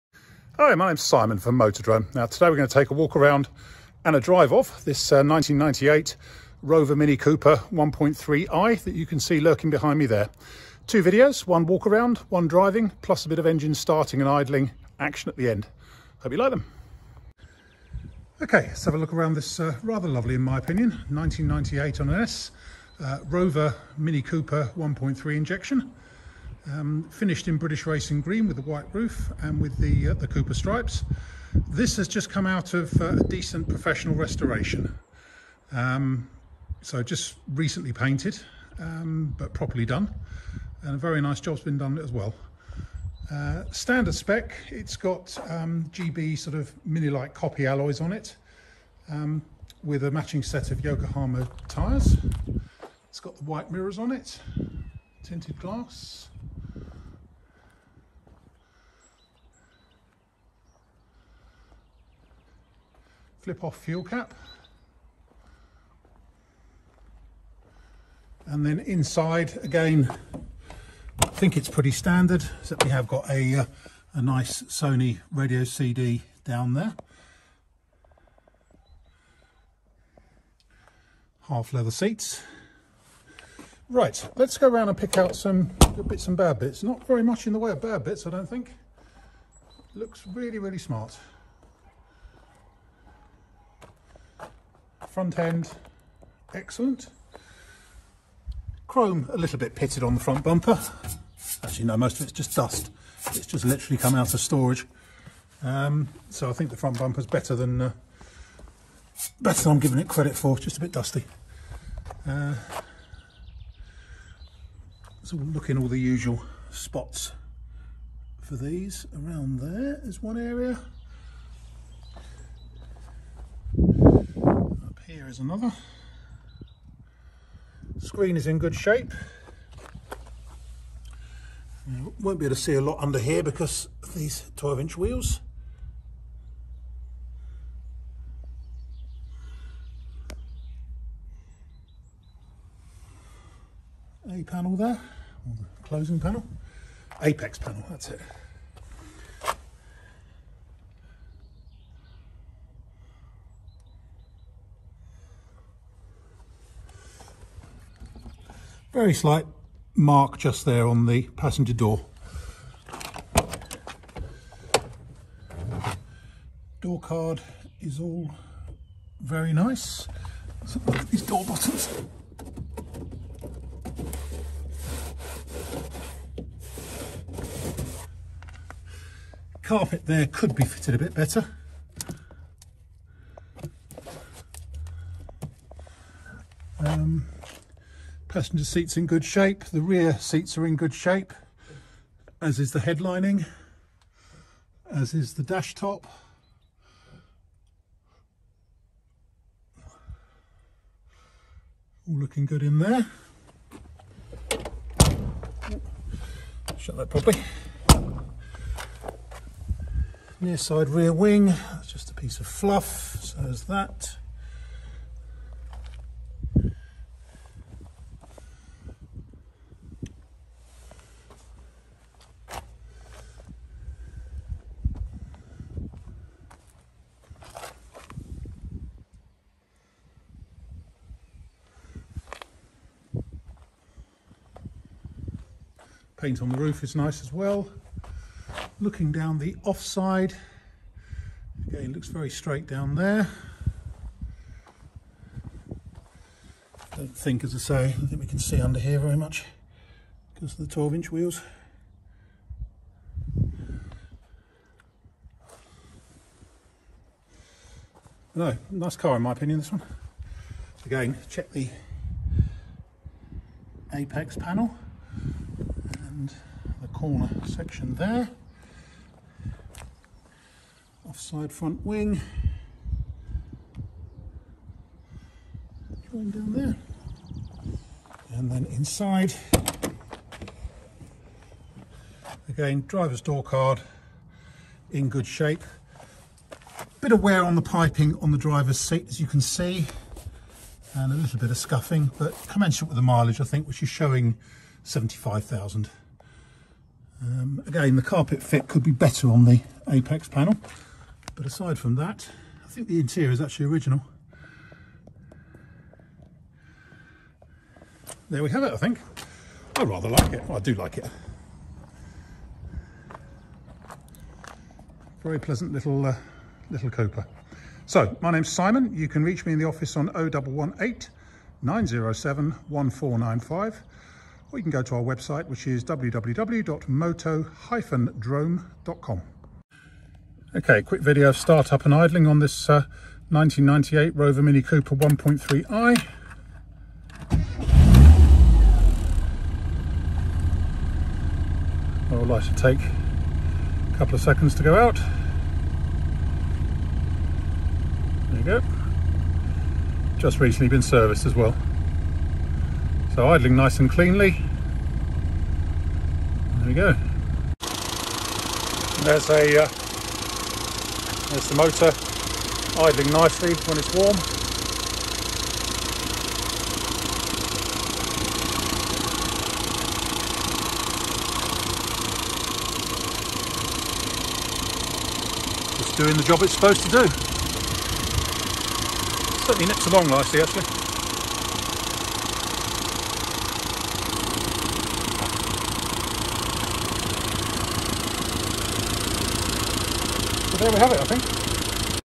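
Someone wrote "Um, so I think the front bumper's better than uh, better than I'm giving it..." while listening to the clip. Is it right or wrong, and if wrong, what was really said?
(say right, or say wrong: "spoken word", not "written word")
right.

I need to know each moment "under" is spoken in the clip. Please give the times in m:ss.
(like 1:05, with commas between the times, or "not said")
2:13, 4:08.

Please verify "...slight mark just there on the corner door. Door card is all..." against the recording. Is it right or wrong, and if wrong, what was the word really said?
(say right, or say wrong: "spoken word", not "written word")
wrong: "passenger", not "corner".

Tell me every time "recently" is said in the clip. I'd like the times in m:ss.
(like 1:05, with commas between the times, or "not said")
0:37, 5:50.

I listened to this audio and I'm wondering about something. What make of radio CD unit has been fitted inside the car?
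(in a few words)
Sony.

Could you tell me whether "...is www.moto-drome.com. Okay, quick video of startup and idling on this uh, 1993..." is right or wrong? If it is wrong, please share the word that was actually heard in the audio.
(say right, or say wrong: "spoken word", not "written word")
wrong: "1998", not "1993".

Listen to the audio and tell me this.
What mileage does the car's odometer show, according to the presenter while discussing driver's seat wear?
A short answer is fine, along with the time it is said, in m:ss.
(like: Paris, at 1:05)
75,000, at 4:54.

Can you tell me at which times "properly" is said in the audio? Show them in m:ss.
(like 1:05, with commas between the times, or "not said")
0:39, 3:27.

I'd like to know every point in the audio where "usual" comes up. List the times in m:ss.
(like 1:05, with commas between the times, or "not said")
1:55.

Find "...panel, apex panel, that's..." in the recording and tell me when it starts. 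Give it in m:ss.
2:26.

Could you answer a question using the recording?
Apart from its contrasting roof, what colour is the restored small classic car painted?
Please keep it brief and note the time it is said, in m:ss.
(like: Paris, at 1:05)
British Racing Green, at 0:27.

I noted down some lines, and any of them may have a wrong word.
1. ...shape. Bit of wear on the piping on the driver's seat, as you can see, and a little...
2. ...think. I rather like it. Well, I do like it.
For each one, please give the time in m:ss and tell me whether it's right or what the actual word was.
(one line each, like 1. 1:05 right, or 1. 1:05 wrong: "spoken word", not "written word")
1. 4:45 right
2. 5:08 right.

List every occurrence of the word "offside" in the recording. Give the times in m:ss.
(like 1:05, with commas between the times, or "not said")
3:59, 4:31.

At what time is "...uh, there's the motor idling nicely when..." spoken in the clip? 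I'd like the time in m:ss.
5:59.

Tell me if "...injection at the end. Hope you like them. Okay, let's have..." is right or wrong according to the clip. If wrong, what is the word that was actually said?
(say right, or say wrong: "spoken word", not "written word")
wrong: "action", not "injection".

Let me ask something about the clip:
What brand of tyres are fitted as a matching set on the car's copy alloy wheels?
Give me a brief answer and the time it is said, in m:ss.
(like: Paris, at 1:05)
Yokohama, at 0:50.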